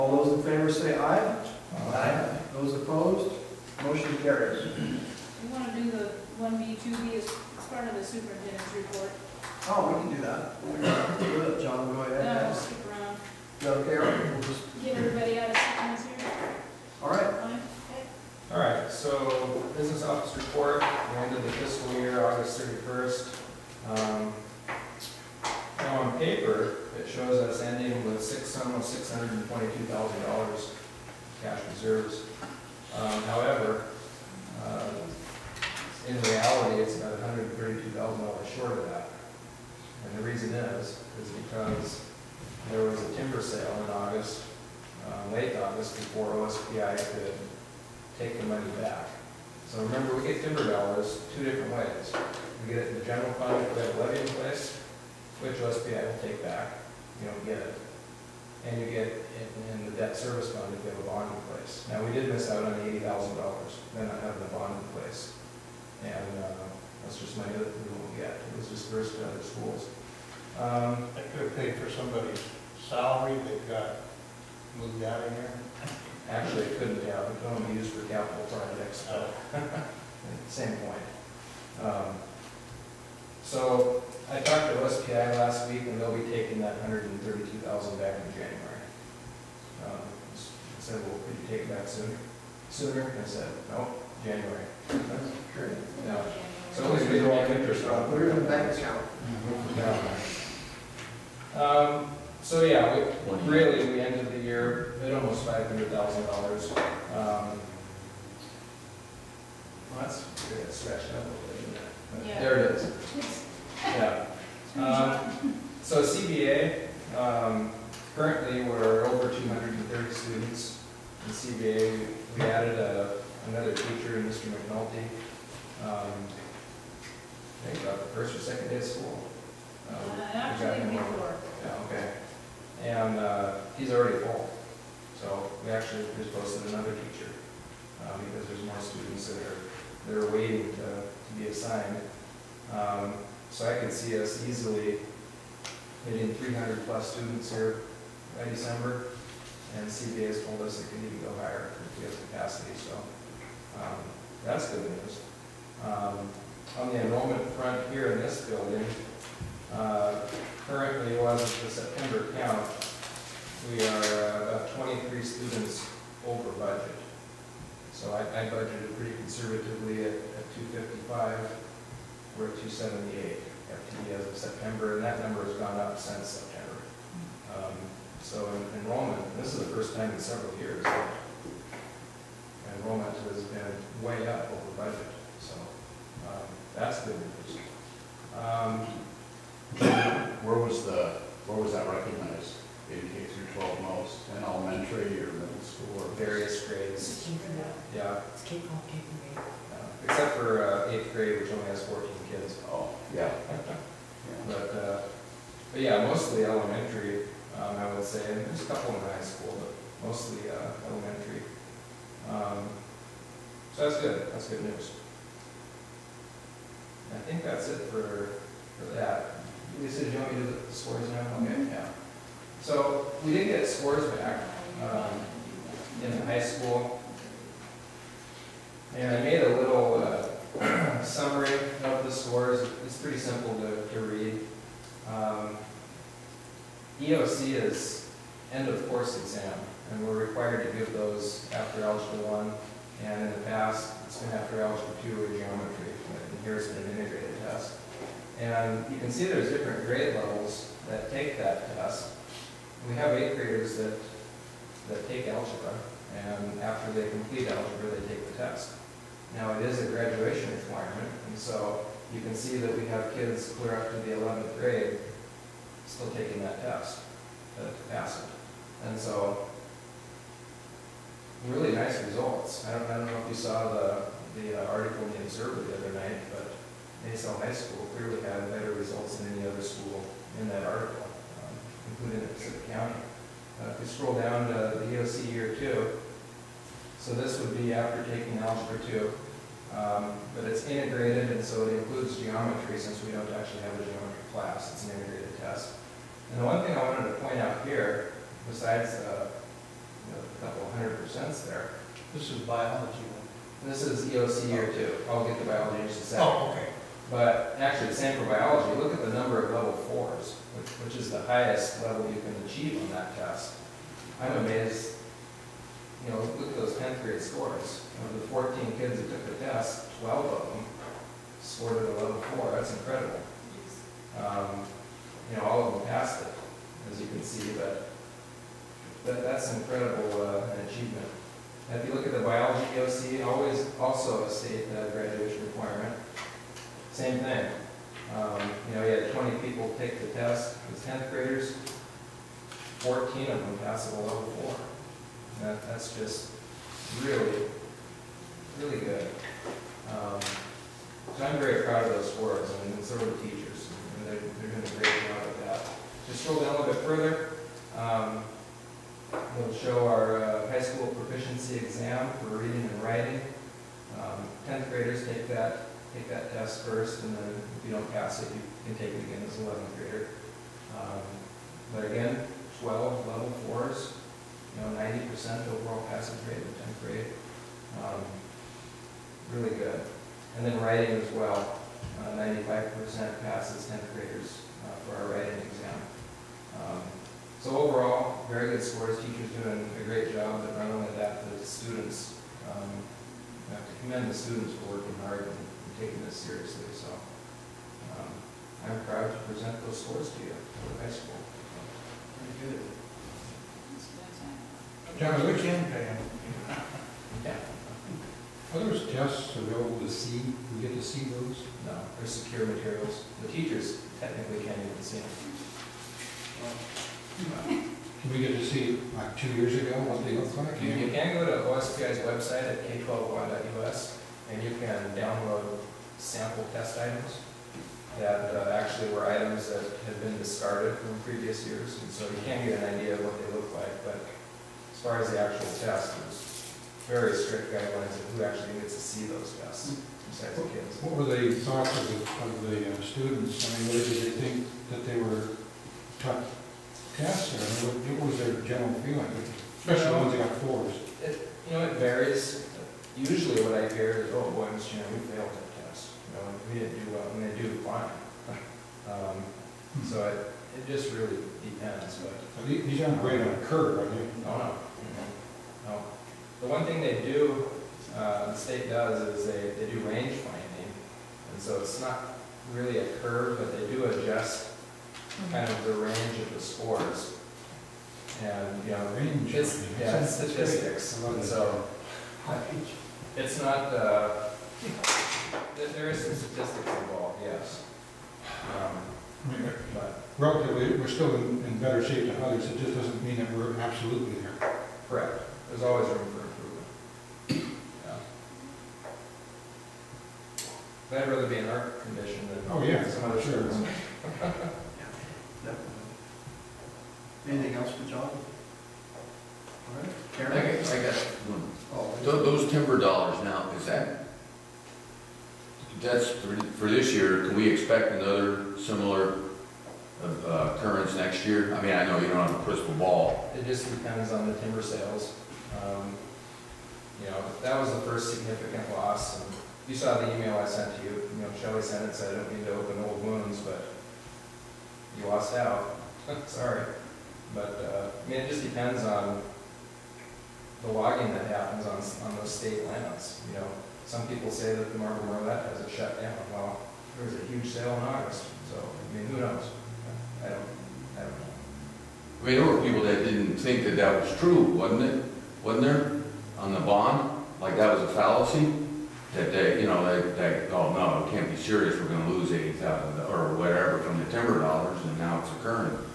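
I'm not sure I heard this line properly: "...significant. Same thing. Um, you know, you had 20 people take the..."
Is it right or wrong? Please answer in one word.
wrong.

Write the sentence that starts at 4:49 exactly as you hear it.
Um, but it's integrated, and so it includes geometry since we don't actually have a geometry class.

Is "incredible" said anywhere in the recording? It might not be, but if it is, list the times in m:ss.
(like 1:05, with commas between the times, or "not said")
5:22, 5:29.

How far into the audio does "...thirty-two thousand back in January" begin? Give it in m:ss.
1:27.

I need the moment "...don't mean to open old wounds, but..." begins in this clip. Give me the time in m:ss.
8:52.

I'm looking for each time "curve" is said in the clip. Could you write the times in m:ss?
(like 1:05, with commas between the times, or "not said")
7:43, 7:52.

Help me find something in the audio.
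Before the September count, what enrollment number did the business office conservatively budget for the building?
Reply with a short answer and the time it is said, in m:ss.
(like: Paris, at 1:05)
255, at 2:50.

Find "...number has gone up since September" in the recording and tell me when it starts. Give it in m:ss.
2:55.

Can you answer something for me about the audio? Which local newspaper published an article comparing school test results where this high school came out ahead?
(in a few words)
the Observer.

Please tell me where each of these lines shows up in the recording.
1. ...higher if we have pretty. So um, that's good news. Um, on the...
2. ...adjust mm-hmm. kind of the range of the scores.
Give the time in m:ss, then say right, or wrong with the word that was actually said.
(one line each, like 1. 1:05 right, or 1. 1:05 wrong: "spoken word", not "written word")
1. 2:31 wrong: "capacity", not "pretty"
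2. 7:53 right.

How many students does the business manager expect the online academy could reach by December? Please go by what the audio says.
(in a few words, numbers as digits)
300 plus.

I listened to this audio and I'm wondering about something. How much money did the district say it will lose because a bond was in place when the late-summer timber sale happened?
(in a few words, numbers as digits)
$80,000.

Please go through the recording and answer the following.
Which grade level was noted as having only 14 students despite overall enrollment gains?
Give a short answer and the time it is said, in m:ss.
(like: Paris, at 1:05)
eighth grade, at 3:20.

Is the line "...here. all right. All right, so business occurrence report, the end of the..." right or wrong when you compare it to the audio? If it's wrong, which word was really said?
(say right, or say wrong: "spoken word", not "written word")
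wrong: "office", not "occurrence".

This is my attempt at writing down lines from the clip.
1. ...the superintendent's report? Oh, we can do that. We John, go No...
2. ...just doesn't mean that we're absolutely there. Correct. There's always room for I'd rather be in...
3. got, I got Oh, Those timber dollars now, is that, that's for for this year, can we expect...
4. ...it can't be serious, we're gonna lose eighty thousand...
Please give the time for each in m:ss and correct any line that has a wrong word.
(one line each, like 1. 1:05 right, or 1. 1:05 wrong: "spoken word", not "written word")
1. 0:07 right
2. 8:12 right
3. 8:30 right
4. 9:21 right.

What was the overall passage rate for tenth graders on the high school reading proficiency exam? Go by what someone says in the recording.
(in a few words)
90%.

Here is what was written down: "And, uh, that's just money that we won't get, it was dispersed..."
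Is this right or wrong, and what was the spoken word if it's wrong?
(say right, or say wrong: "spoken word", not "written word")
right.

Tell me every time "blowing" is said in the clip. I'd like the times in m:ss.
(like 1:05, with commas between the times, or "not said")
not said.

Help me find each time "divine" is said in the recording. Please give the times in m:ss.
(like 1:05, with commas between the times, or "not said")
not said.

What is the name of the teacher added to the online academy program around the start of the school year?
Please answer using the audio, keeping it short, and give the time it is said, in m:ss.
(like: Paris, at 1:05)
Mr. McNulty, at 2:04.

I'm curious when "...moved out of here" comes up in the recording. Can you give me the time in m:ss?
1:14.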